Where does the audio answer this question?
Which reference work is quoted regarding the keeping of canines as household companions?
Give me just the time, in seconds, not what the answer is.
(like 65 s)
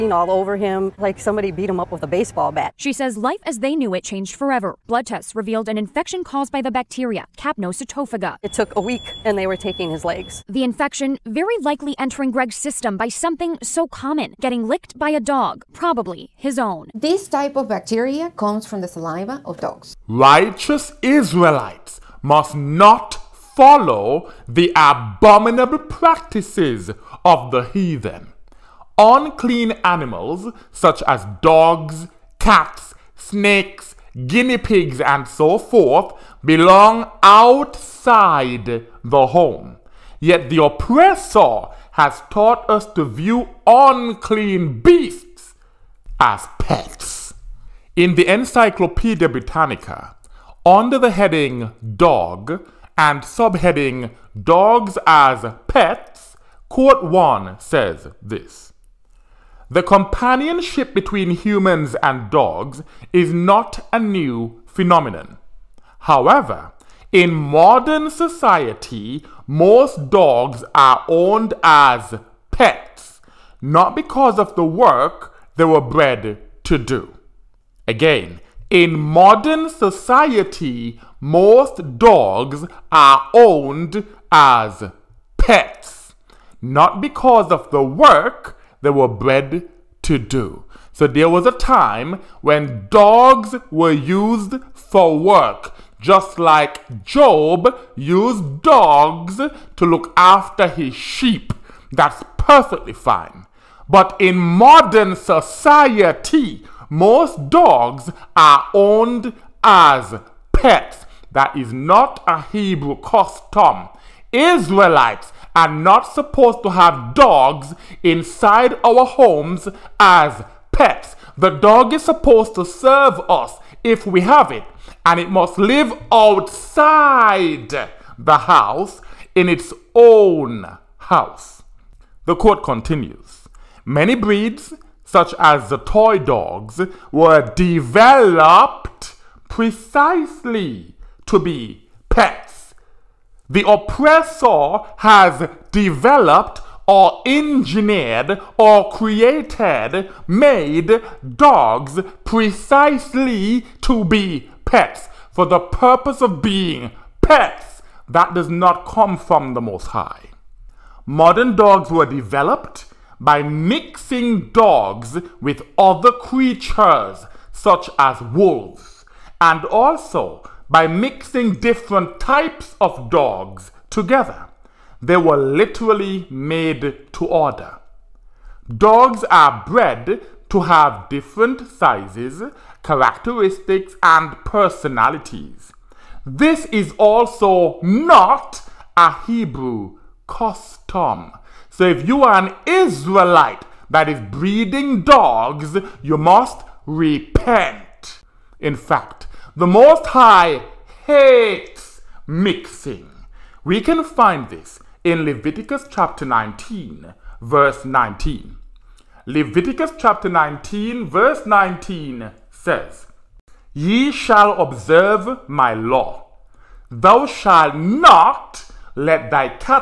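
48 s.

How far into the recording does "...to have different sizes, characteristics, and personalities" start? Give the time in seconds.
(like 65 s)
180 s.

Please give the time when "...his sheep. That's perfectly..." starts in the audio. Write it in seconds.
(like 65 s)
100 s.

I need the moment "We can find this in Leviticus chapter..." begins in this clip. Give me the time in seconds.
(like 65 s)
203 s.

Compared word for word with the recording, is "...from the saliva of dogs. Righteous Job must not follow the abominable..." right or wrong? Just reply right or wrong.
wrong.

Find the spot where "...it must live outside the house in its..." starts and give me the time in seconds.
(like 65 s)
125 s.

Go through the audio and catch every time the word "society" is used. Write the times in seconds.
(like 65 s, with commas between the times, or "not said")
68 s, 79 s, 105 s.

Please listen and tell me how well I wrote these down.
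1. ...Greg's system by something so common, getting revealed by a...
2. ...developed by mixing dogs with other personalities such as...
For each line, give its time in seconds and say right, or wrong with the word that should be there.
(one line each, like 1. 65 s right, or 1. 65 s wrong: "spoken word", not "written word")
1. 12 s wrong: "licked", not "revealed"
2. 162 s wrong: "creatures", not "personalities".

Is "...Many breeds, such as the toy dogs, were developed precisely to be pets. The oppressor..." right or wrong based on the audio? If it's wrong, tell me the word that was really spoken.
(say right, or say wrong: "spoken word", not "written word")
right.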